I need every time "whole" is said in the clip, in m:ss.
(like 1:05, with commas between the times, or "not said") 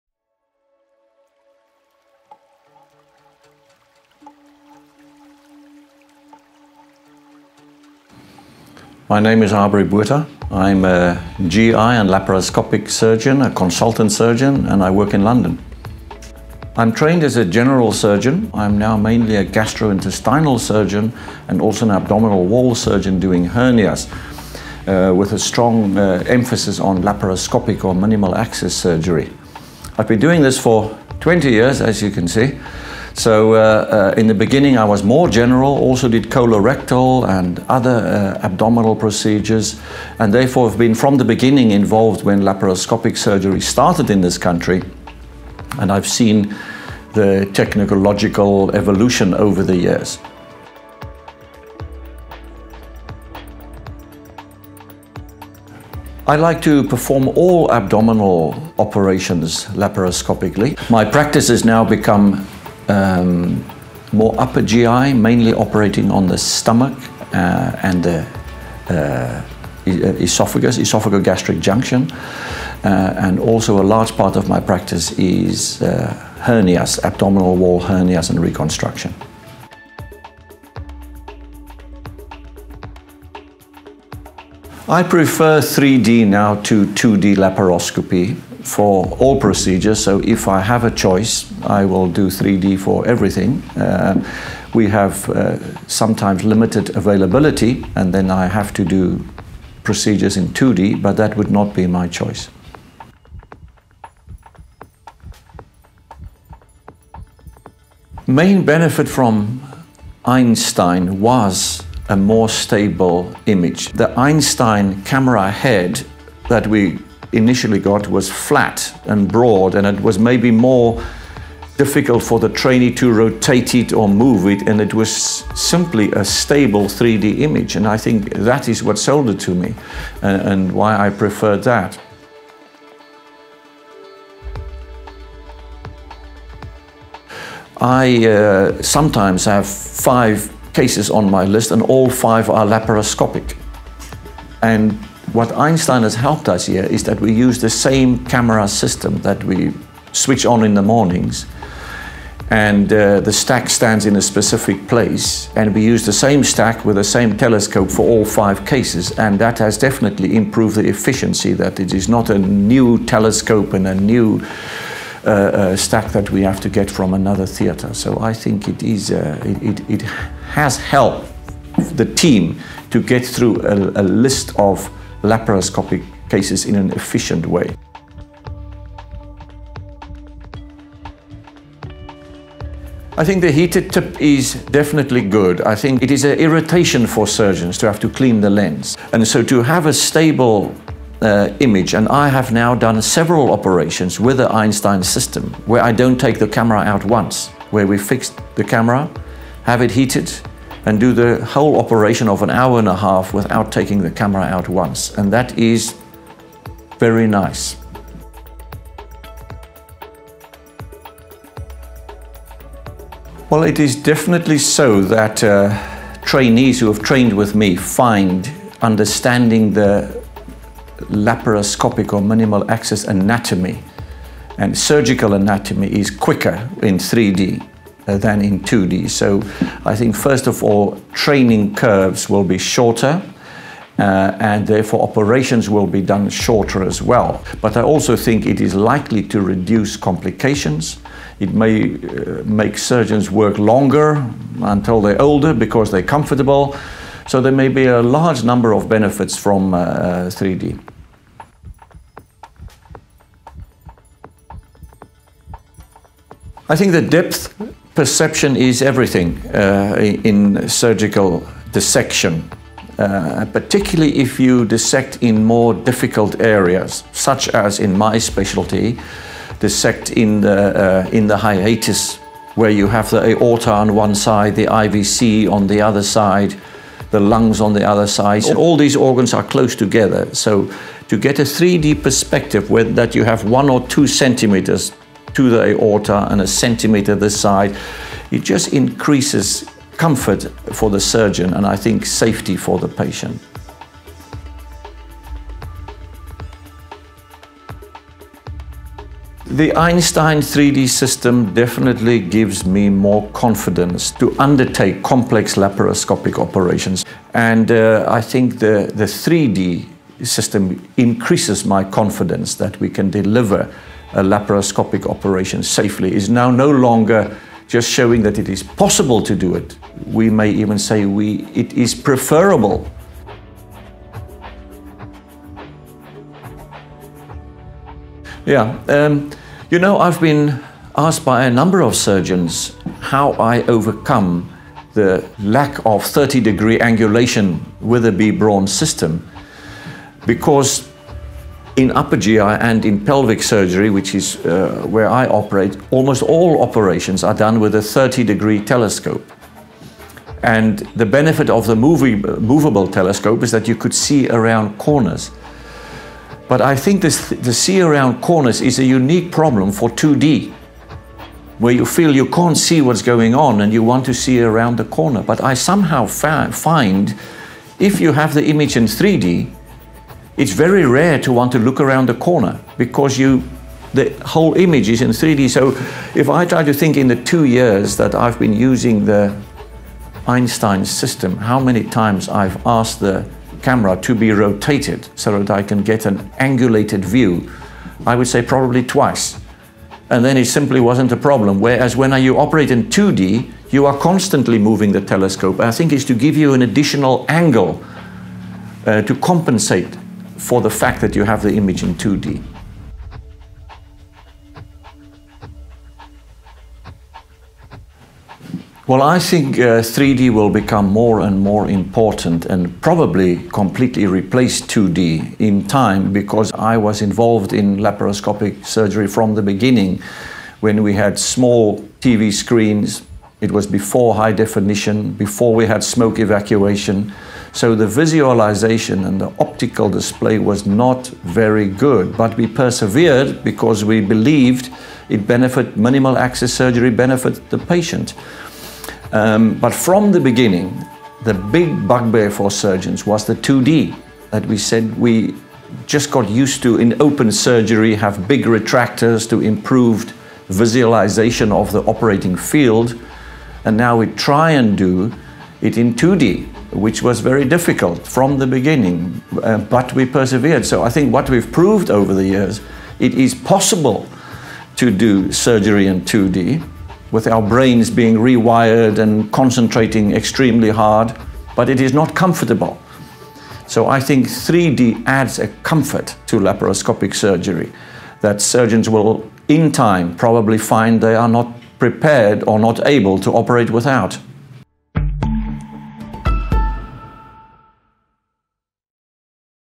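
3:21, 6:14.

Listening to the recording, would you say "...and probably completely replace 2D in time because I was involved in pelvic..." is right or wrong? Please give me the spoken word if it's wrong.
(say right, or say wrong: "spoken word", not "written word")
wrong: "laparoscopic", not "pelvic".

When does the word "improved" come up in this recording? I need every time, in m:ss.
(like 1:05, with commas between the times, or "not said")
2:40, 7:29.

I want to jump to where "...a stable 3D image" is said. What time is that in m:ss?
2:06.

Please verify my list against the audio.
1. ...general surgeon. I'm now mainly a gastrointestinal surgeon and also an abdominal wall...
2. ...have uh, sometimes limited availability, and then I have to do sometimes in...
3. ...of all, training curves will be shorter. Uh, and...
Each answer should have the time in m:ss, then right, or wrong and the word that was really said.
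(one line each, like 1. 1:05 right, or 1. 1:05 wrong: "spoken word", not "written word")
1. 0:17 right
2. 1:34 wrong: "procedures", not "sometimes"
3. 3:50 right.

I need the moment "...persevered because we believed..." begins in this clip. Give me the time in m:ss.
7:12.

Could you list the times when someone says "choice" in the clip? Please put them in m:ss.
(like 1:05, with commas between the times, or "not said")
1:30, 1:42.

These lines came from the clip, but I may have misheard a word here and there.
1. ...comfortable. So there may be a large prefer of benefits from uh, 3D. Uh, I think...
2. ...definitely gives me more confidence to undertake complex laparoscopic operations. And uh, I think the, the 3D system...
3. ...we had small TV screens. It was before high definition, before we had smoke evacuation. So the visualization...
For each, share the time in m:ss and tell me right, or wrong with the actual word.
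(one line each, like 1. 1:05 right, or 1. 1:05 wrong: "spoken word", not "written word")
1. 4:06 wrong: "number", not "prefer"
2. 5:01 right
3. 7:00 right.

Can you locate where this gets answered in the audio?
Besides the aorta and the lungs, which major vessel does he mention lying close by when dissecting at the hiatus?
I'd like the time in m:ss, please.
4:34.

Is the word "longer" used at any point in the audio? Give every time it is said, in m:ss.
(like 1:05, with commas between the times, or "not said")
4:03, 5:16.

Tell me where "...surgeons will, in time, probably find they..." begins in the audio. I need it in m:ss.
7:58.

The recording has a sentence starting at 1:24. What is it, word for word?
I prefer 3D now to 2D laparoscopy for all procedures.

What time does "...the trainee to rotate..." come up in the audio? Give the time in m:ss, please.
2:02.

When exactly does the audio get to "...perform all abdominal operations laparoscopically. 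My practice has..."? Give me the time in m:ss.
0:56.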